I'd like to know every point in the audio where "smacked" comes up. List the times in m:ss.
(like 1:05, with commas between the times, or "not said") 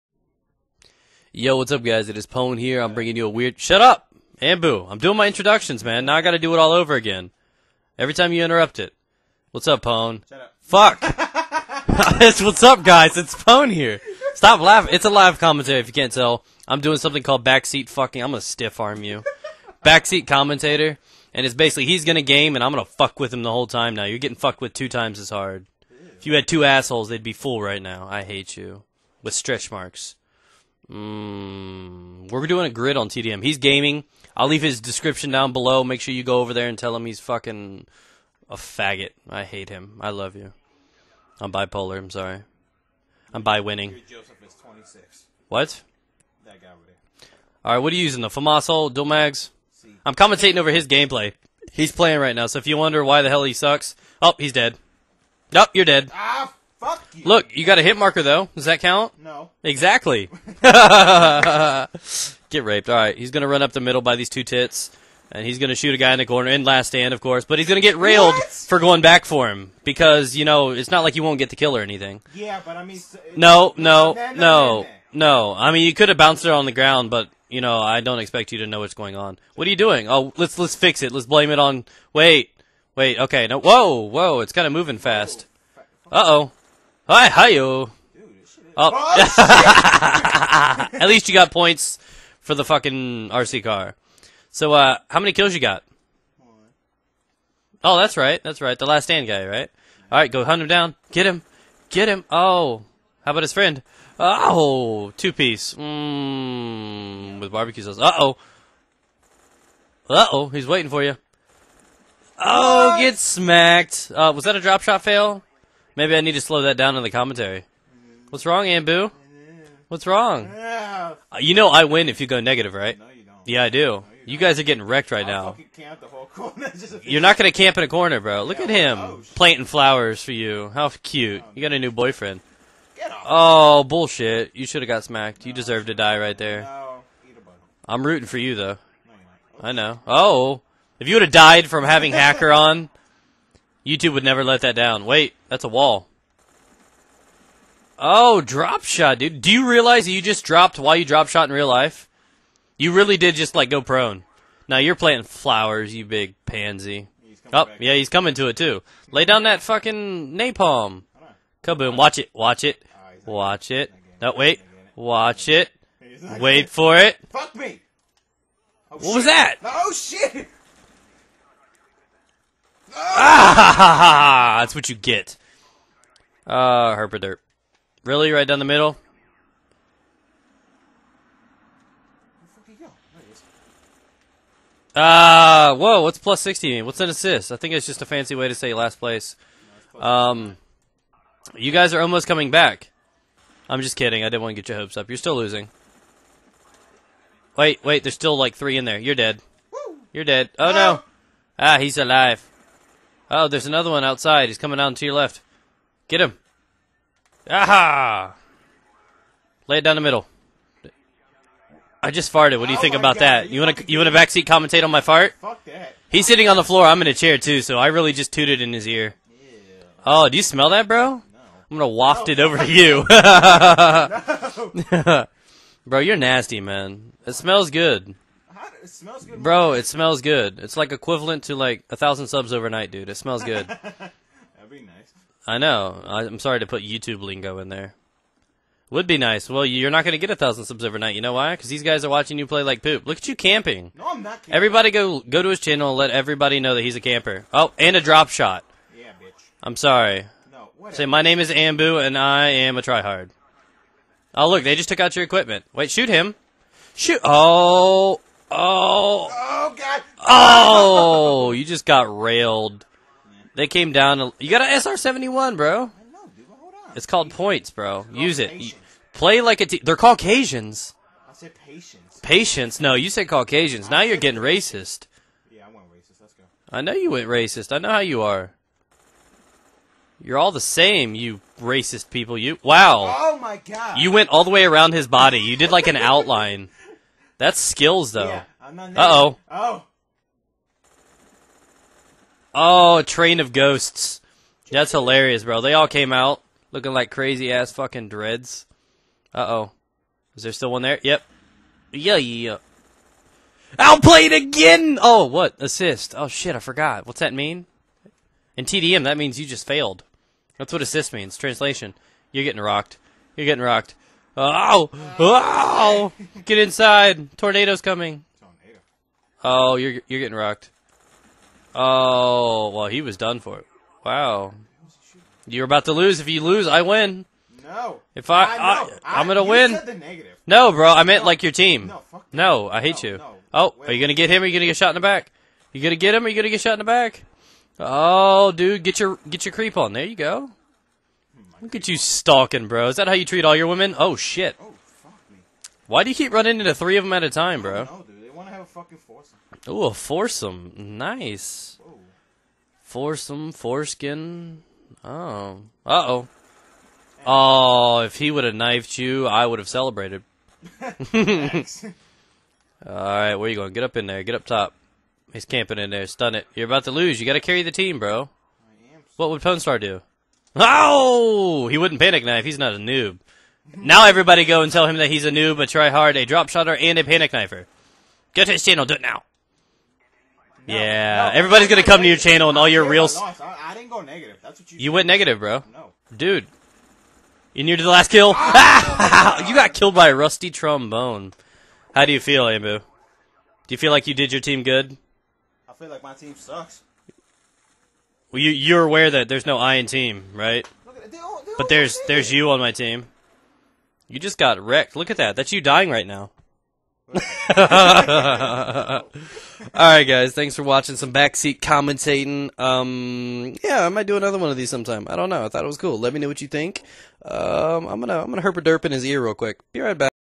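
1:53, 2:15.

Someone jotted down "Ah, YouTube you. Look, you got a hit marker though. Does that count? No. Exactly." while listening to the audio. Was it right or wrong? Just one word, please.
wrong.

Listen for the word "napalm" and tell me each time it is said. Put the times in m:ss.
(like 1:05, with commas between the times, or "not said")
2:40.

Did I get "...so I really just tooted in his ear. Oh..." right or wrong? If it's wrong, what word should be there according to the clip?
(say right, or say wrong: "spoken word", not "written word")
right.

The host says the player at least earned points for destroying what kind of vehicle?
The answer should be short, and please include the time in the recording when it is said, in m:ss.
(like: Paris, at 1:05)
RC car, at 1:33.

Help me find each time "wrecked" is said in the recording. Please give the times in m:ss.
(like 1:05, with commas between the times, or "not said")
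2:04, 6:44.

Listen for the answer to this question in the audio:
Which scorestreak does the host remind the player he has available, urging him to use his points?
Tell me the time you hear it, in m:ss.
4:24.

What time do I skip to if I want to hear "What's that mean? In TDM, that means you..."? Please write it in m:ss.
5:07.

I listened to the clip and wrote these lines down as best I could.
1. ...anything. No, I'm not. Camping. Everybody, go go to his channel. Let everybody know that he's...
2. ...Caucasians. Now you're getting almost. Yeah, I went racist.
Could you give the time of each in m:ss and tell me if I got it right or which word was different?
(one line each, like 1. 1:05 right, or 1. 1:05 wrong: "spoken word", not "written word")
1. 4:03 wrong: "camping", not "anything"
2. 4:33 wrong: "racist", not "almost".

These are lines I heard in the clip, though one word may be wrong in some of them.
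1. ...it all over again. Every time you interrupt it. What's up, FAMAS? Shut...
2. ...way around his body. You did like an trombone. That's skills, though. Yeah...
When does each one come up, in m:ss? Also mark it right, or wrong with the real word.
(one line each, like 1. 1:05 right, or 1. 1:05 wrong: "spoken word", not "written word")
1. 0:06 wrong: "Pwn", not "FAMAS"
2. 4:44 wrong: "outline", not "trombone".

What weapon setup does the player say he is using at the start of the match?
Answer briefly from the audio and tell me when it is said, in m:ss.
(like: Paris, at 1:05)
FAMAS dual mags, at 0:48.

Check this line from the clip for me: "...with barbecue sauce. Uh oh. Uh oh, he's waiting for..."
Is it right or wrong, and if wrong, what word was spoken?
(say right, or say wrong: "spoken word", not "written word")
right.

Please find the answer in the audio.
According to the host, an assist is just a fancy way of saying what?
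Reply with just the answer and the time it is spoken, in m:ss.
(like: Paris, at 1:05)
last place, at 3:08.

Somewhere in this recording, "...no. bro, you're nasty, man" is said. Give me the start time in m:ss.
3:44.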